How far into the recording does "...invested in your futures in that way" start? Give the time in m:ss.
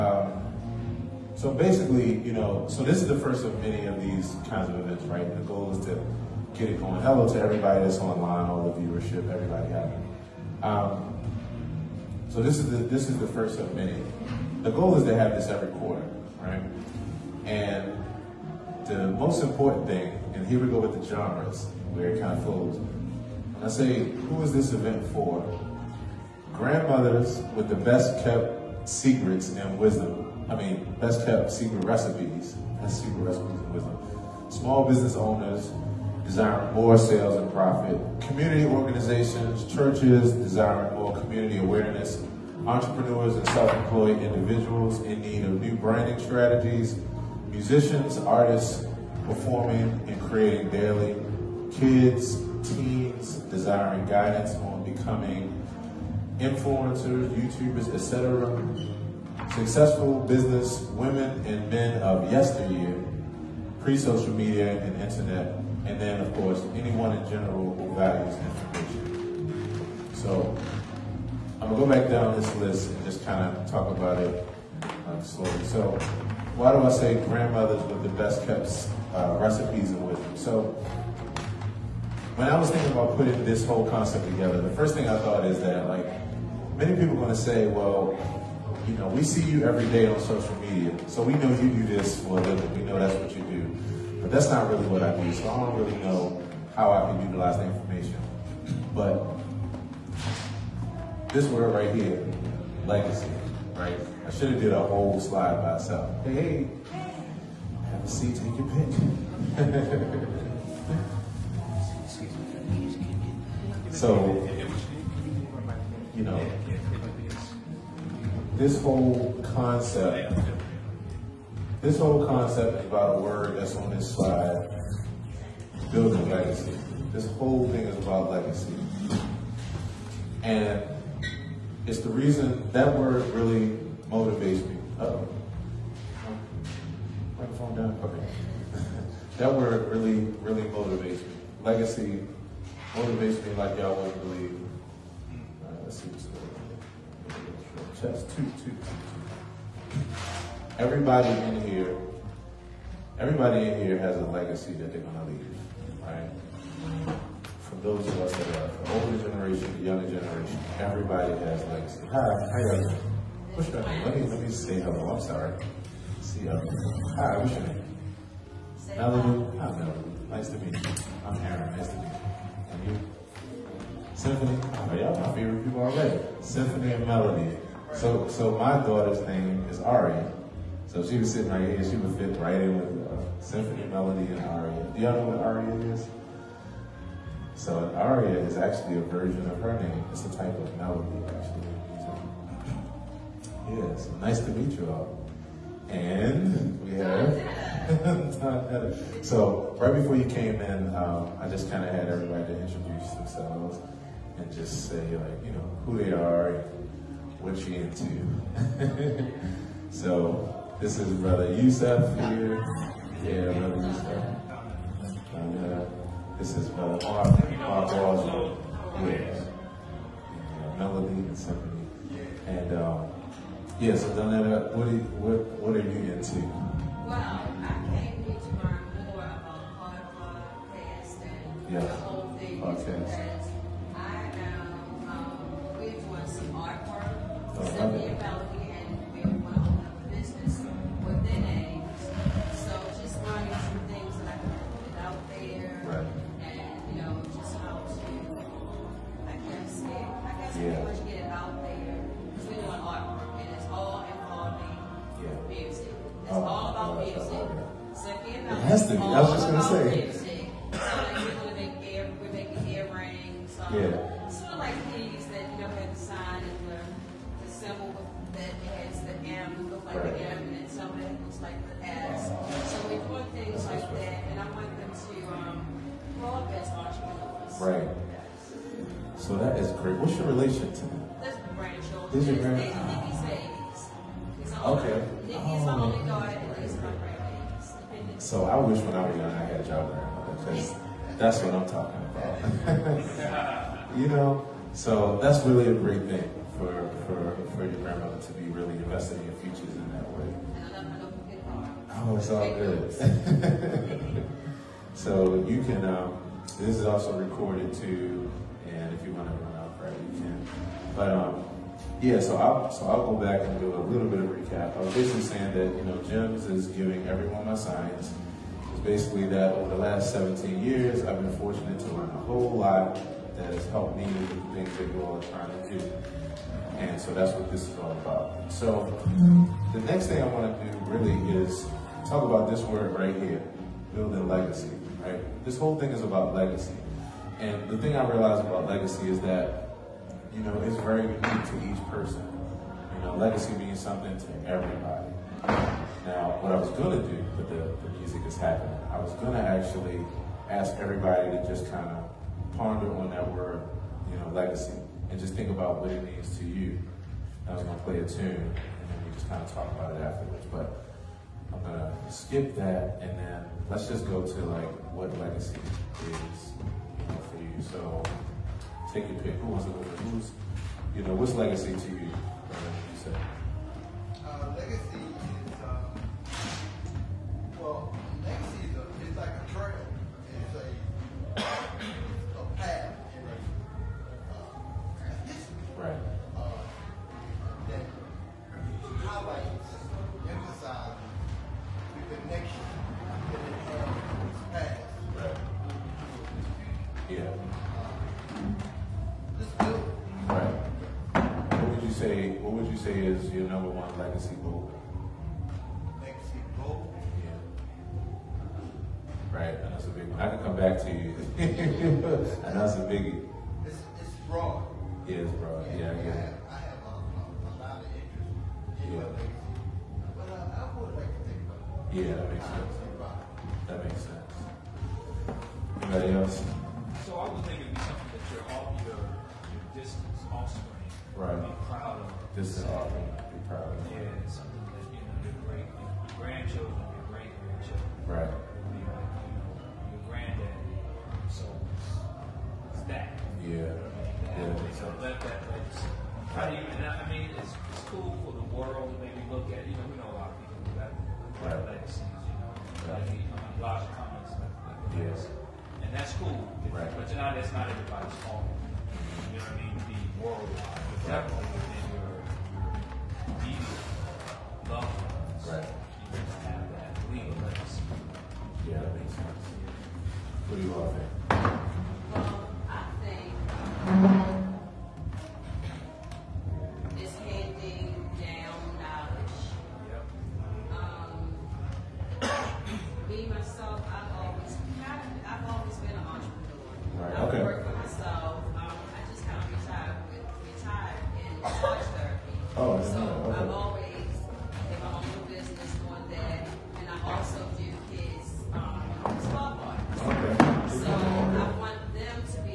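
4:58.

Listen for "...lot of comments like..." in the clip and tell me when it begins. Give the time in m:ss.
7:33.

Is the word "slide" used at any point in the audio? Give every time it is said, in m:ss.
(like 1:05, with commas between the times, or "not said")
1:45, 2:04.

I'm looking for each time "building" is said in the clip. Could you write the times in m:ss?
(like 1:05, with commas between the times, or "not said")
2:05, 5:33.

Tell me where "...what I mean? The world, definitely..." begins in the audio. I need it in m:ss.
7:39.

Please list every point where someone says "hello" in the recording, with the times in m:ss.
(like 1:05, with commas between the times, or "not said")
0:07, 2:44.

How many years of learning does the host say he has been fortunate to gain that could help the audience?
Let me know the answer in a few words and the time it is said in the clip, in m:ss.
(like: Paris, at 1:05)
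17, at 5:20.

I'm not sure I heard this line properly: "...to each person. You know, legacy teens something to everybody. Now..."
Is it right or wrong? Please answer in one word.
wrong.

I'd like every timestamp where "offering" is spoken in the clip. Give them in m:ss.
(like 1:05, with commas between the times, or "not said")
7:12.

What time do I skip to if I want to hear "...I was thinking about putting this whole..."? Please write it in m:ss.
1:22.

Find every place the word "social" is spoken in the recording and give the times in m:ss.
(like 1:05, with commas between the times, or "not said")
1:03, 1:30.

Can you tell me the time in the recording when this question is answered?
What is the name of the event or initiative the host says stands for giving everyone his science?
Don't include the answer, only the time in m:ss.
5:16.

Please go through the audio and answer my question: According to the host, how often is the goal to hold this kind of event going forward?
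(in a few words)
Every quarter.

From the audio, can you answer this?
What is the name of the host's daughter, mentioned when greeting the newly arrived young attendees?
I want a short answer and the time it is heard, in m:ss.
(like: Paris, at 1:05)
Ari, at 2:59.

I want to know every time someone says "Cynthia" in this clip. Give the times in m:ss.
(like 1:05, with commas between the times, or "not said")
3:57.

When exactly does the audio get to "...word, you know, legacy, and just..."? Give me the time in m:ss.
5:53.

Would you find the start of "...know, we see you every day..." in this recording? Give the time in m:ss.
1:28.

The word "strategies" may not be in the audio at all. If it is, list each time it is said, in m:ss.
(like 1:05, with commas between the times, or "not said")
0:46.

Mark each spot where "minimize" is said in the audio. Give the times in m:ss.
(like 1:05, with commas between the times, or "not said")
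not said.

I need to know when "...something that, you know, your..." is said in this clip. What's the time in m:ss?
7:14.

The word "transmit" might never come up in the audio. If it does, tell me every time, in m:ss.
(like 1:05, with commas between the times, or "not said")
not said.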